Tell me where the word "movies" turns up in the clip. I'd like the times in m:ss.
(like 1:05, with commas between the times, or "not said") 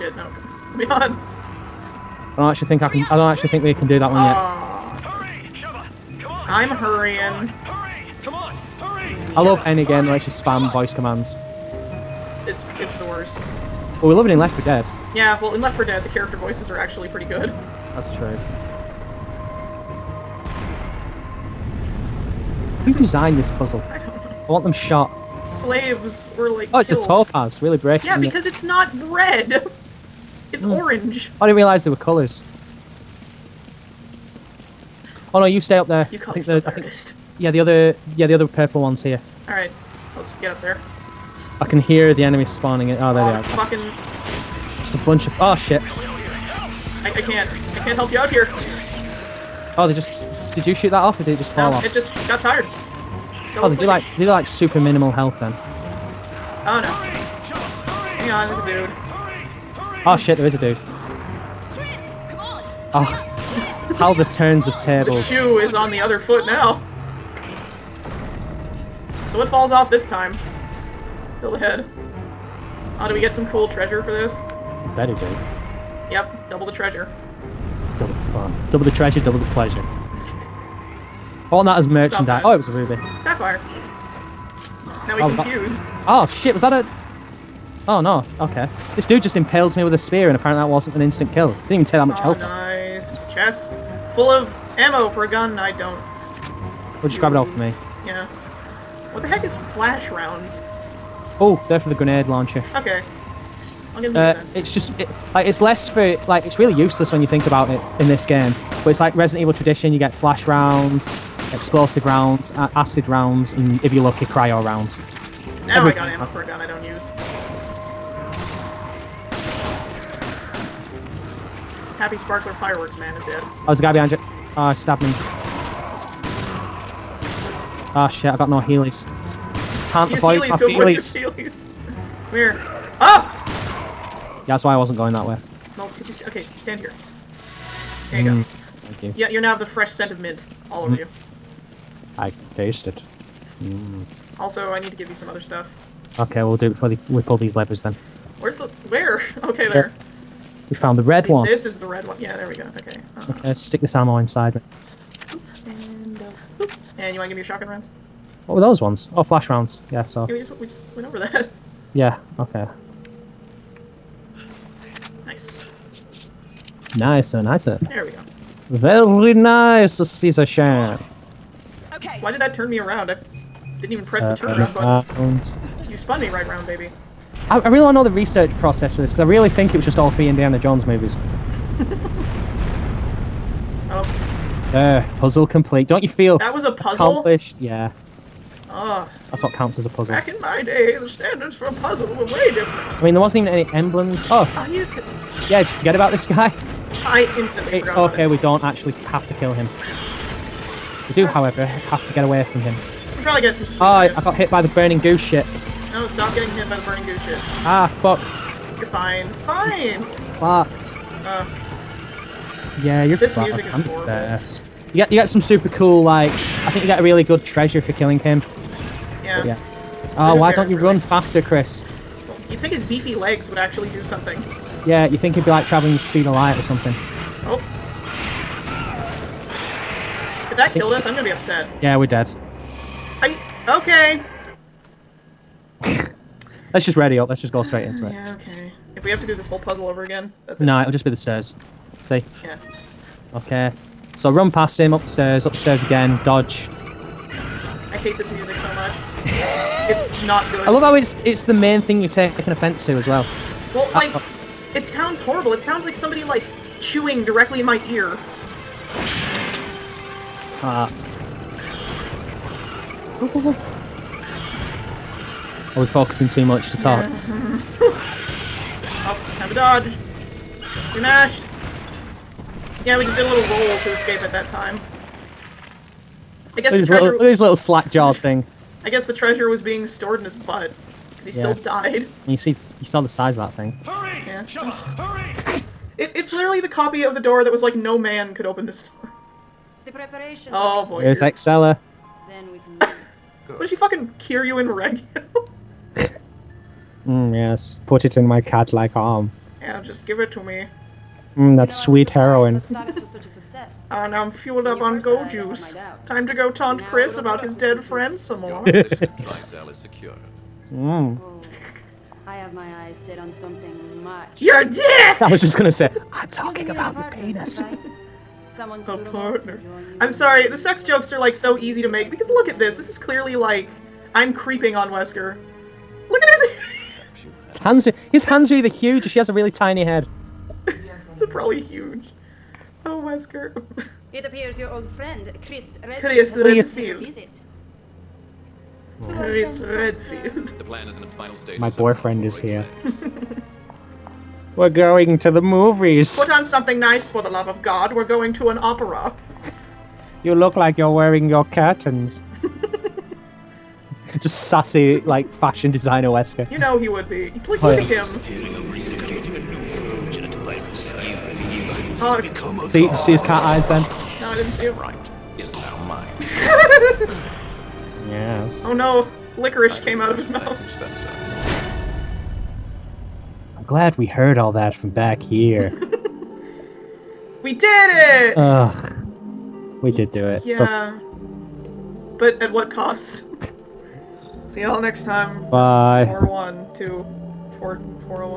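3:00, 5:45.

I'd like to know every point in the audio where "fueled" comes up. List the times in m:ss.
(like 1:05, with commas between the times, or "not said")
5:04.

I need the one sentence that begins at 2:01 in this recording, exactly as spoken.
Happy Sparkler Fireworks Man is dead.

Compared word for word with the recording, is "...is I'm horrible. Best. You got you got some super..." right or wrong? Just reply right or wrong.
right.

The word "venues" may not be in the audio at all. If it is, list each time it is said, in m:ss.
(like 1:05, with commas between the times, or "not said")
not said.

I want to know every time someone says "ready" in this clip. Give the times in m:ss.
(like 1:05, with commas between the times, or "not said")
3:56.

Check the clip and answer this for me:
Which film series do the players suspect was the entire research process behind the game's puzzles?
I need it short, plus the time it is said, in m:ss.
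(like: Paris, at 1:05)
Indiana Jones, at 3:00.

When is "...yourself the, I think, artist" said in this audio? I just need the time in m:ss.
0:36.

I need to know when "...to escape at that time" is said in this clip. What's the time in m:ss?
4:33.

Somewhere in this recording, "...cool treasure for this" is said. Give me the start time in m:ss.
1:13.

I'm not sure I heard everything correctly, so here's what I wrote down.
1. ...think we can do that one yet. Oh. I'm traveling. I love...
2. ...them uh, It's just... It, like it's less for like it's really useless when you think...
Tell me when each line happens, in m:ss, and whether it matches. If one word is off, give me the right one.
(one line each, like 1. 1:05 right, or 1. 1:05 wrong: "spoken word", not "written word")
1. 0:03 wrong: "hurrying", not "traveling"
2. 1:44 right.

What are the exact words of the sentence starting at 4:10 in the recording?
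I love how it's it's the main thing you take an offence to as well.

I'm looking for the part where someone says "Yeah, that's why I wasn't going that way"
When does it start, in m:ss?
2:14.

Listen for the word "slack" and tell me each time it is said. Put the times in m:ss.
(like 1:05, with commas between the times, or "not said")
4:37.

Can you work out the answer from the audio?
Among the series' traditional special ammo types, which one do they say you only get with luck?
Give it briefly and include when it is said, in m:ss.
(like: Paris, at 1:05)
cryo rounds, at 1:54.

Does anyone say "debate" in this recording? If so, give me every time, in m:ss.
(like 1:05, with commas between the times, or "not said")
not said.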